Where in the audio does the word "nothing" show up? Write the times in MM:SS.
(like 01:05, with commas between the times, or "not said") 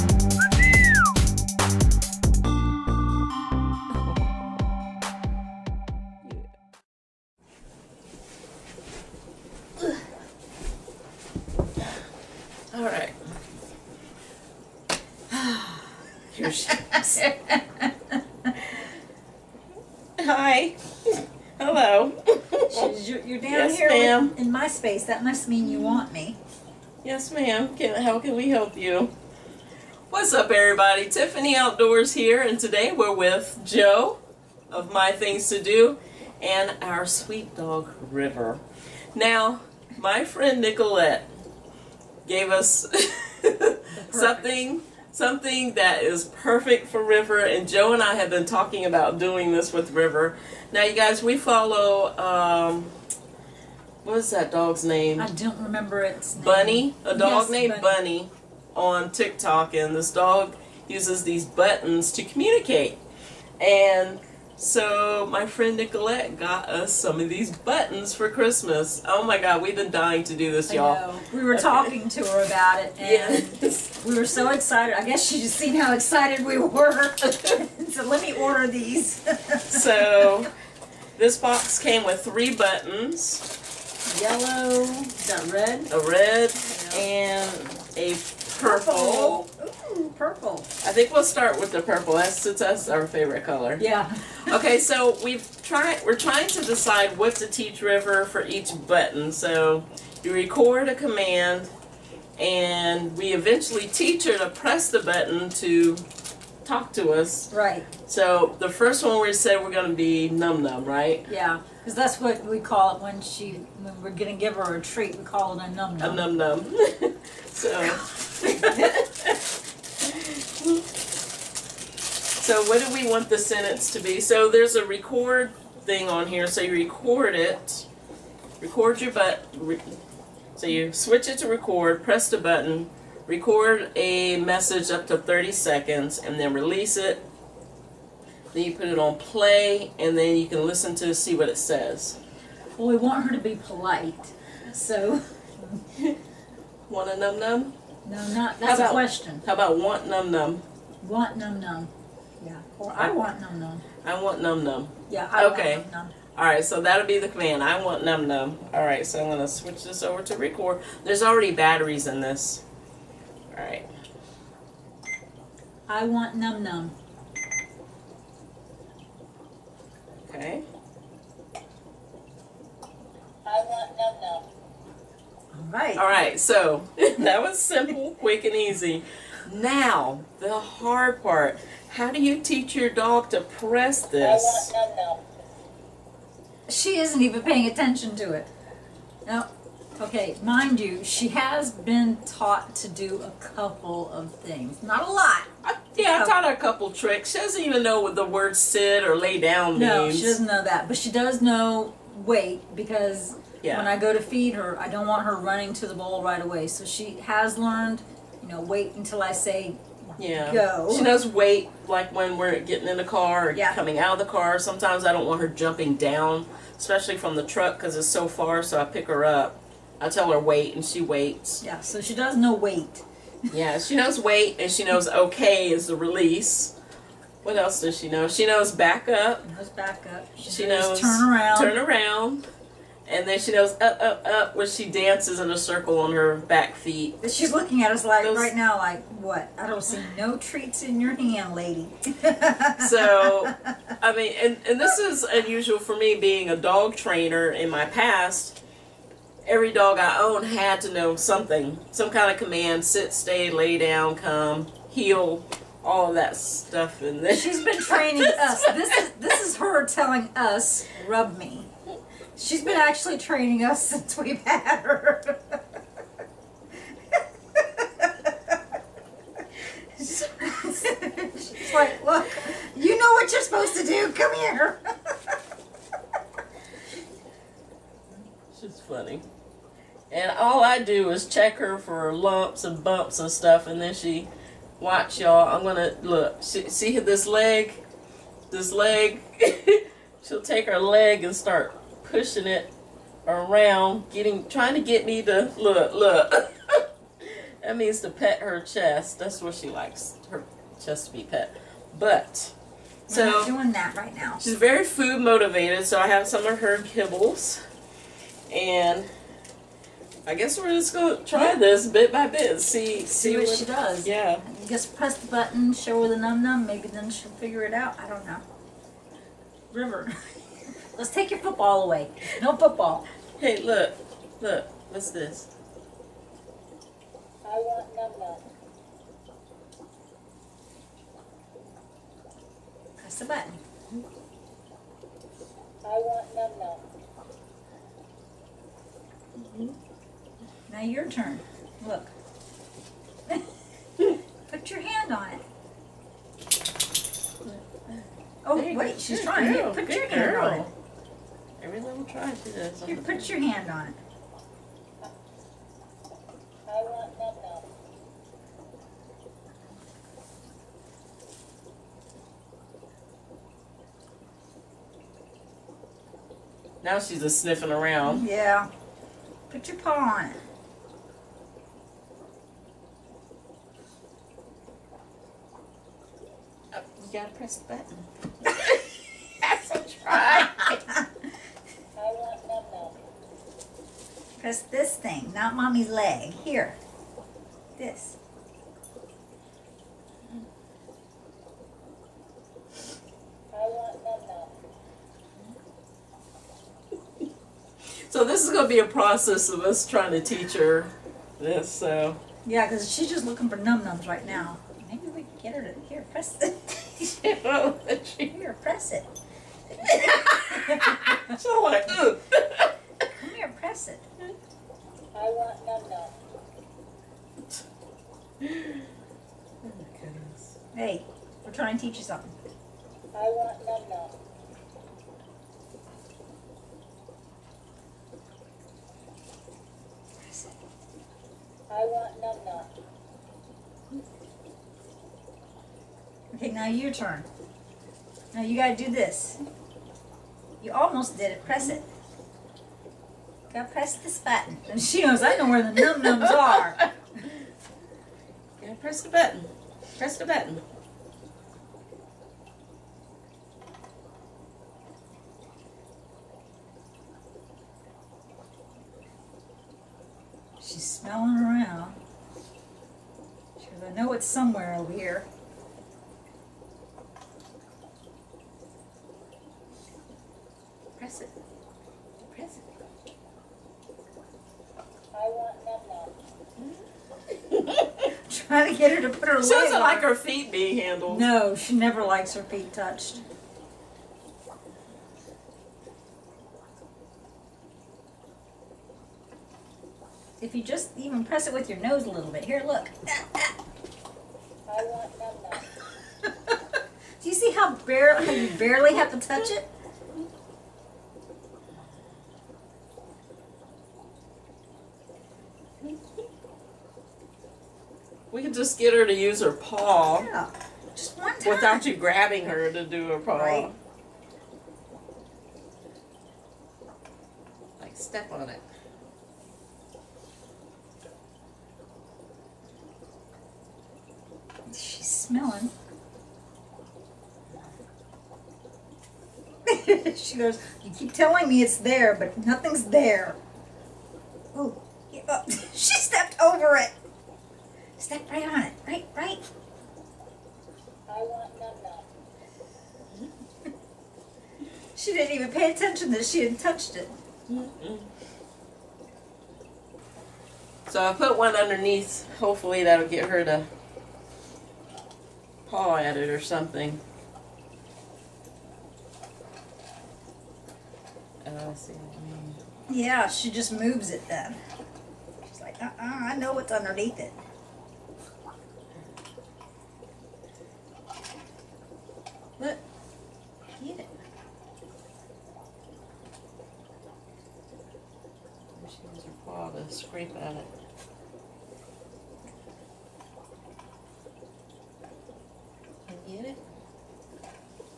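08:52.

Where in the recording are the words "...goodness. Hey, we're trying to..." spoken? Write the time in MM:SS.
07:00.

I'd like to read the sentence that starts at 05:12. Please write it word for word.
See, see, see what, what, she does.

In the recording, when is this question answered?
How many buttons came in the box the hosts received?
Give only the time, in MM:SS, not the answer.
01:22.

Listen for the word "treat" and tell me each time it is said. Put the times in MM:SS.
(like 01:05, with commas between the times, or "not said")
01:54, 04:00.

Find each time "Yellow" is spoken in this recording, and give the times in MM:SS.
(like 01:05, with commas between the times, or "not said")
01:24.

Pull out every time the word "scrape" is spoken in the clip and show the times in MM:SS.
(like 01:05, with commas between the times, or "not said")
09:39.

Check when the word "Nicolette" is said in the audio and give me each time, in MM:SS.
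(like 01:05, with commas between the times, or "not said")
00:40, 01:05.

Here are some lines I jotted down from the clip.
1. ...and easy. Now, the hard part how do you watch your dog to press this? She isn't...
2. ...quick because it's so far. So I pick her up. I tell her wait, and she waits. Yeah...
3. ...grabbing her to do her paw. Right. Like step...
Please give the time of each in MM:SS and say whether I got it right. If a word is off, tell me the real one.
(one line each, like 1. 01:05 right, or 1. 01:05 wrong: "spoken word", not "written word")
1. 02:58 wrong: "teach", not "watch"
2. 03:37 wrong: "truck", not "quick"
3. 08:31 right.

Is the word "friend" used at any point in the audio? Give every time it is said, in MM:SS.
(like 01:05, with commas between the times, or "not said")
00:40, 01:05.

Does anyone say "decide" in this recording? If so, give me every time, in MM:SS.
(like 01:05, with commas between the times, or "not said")
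01:36.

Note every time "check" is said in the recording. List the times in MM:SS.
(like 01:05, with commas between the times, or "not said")
04:41.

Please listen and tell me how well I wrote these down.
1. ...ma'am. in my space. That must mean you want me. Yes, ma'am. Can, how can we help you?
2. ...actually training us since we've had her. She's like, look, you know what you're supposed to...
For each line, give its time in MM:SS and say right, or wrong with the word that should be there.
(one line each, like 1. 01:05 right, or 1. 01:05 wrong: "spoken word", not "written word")
1. 00:23 right
2. 04:22 right.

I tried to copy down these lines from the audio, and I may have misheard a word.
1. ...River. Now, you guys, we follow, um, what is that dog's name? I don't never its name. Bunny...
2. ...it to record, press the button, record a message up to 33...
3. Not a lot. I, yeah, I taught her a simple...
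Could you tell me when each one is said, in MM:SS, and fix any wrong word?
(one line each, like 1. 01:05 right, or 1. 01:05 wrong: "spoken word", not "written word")
1. 00:49 wrong: "remember", not "never"
2. 02:11 wrong: "30", not "33"
3. 03:14 wrong: "couple", not "simple".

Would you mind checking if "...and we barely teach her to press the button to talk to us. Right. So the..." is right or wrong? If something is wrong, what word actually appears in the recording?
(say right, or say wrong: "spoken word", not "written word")
wrong: "eventually", not "barely".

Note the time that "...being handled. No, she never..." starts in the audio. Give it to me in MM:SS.
08:00.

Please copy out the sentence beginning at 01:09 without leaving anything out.
Oh my God, we've been dying to do this, y'all.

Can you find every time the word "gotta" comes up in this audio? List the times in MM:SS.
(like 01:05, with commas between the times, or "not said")
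06:17, 07:18.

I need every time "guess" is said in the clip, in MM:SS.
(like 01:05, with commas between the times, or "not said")
01:15, 05:10.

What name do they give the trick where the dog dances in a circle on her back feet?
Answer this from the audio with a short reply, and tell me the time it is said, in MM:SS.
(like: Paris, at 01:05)
Up, up, up, at 03:53.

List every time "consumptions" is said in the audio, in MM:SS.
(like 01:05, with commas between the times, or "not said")
not said.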